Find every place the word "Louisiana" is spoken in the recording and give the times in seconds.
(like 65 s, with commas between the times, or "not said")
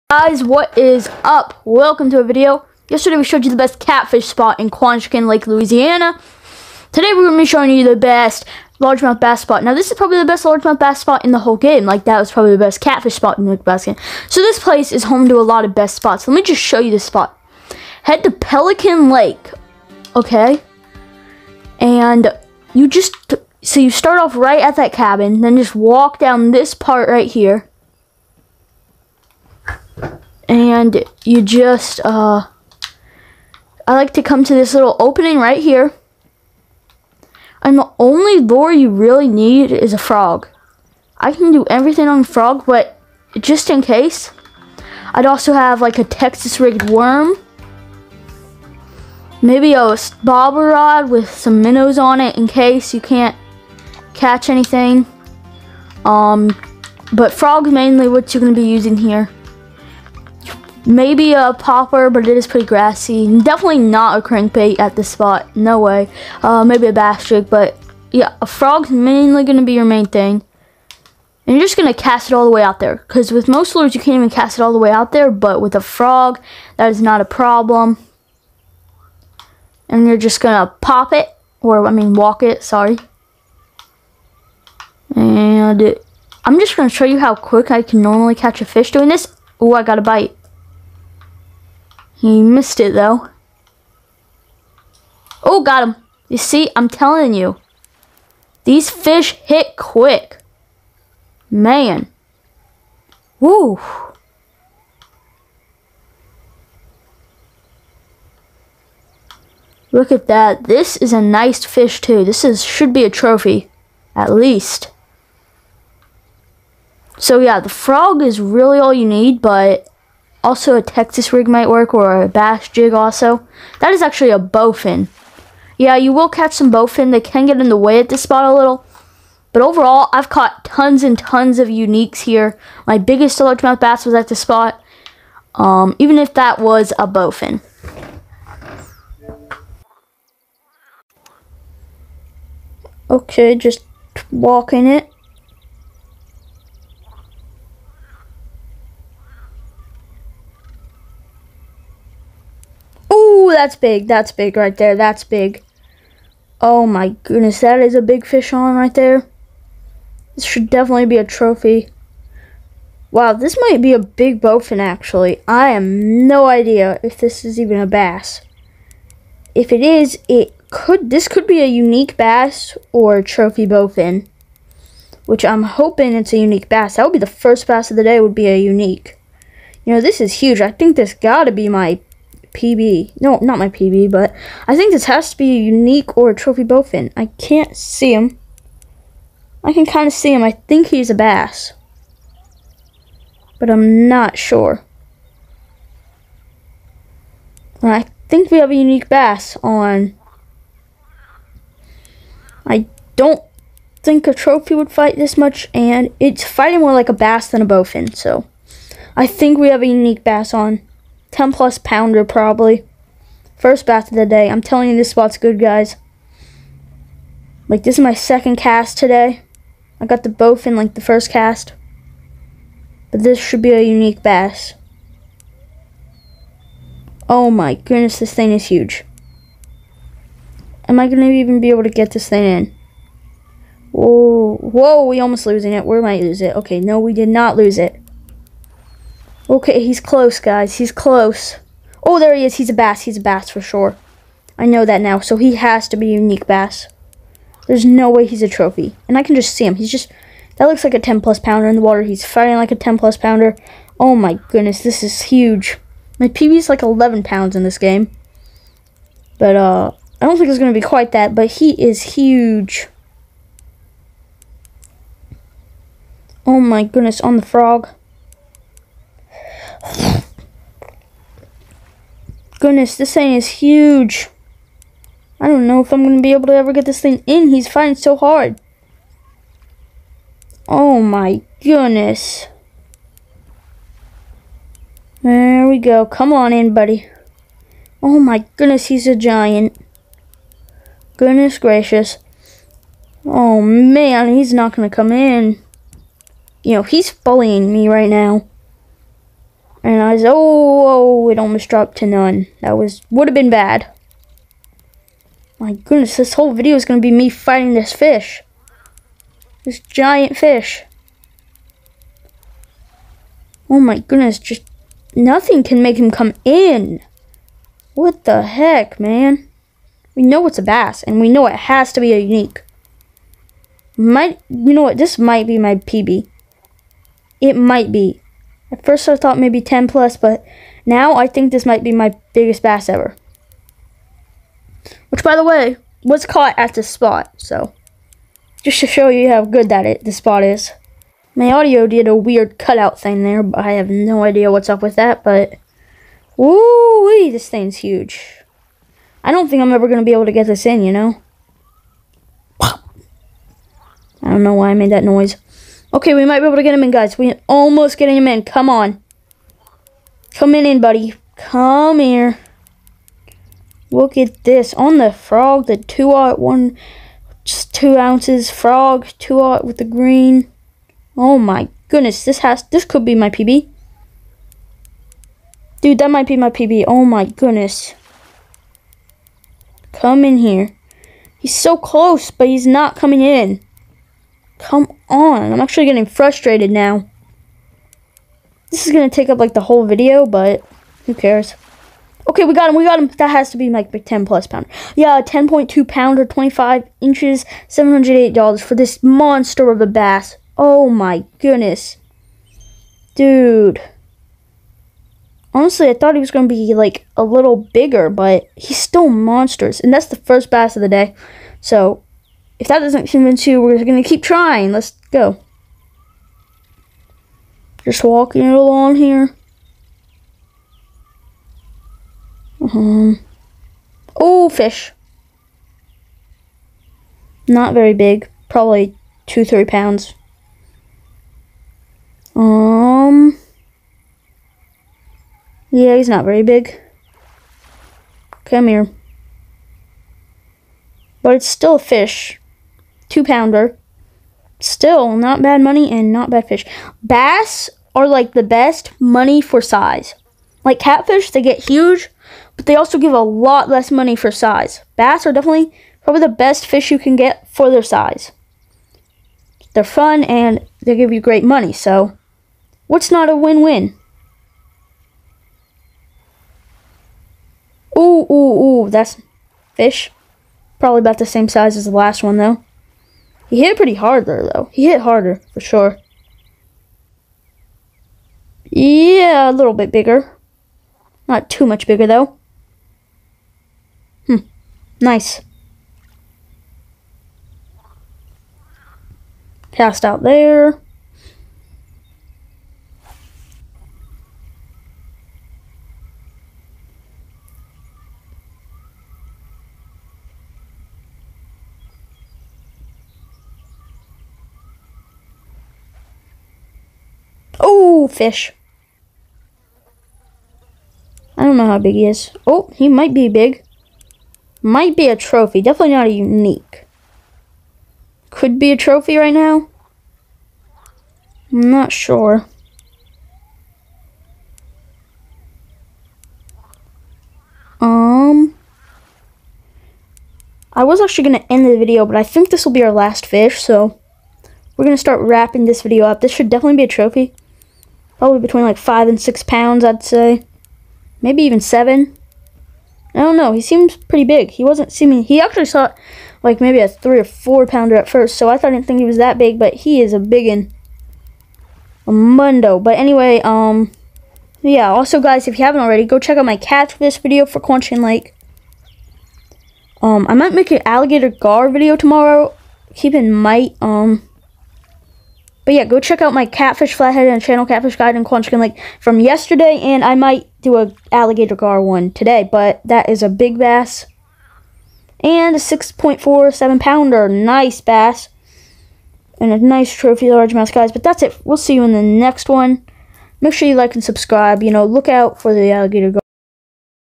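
5 s.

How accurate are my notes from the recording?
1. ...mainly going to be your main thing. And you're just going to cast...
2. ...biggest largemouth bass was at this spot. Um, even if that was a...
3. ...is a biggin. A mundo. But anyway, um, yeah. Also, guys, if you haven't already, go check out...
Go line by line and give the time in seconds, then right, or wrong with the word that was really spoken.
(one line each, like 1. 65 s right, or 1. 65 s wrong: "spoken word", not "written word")
1. 68 s right
2. 132 s right
3. 550 s right.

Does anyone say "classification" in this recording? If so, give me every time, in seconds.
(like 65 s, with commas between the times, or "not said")
not said.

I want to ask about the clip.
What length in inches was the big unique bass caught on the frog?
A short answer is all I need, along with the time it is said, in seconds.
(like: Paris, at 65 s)
25 inches, at 396 s.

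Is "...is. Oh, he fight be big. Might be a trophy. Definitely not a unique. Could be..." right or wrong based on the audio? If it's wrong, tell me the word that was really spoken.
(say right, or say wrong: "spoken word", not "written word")
wrong: "might", not "fight".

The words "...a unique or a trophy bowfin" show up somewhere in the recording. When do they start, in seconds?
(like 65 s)
185 s.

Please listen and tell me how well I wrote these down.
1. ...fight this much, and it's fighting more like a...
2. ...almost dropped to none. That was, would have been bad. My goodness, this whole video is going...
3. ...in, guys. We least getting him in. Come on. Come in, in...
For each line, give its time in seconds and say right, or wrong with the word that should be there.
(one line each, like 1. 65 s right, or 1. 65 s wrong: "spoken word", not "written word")
1. 204 s right
2. 301 s right
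3. 356 s wrong: "almost", not "least".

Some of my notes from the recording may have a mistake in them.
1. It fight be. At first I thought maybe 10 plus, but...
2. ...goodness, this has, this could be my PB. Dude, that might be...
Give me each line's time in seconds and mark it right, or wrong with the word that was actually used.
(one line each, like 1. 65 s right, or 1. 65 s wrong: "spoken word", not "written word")
1. 327 s wrong: "might", not "fight"
2. 371 s right.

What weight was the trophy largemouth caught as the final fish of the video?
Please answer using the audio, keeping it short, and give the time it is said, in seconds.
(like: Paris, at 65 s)
6.47 pounds, at 575 s.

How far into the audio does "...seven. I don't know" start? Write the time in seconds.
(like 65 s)
541 s.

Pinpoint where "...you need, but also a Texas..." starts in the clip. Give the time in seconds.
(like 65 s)
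118 s.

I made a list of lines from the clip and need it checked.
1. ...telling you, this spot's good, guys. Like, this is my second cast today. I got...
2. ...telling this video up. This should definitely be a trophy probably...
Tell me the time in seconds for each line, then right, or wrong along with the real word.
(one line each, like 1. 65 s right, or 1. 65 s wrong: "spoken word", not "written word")
1. 214 s right
2. 535 s wrong: "wrapping", not "telling".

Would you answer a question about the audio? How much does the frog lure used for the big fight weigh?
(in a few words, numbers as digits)
2 ounces.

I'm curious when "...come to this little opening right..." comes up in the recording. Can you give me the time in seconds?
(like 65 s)
34 s.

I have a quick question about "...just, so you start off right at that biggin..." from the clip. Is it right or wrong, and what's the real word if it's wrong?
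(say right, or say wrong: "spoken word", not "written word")
wrong: "cabin", not "biggin".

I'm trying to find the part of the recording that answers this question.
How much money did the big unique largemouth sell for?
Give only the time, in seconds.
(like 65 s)
397 s.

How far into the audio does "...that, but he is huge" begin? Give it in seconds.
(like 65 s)
261 s.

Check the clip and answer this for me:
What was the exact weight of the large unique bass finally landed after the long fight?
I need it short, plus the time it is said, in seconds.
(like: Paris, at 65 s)
10.2 pounds, at 395 s.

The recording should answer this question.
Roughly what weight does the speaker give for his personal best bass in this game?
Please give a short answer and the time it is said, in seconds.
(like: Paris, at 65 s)
11 pounds, at 256 s.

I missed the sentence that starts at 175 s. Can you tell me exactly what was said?
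Which I'm hoping it's a unique bass.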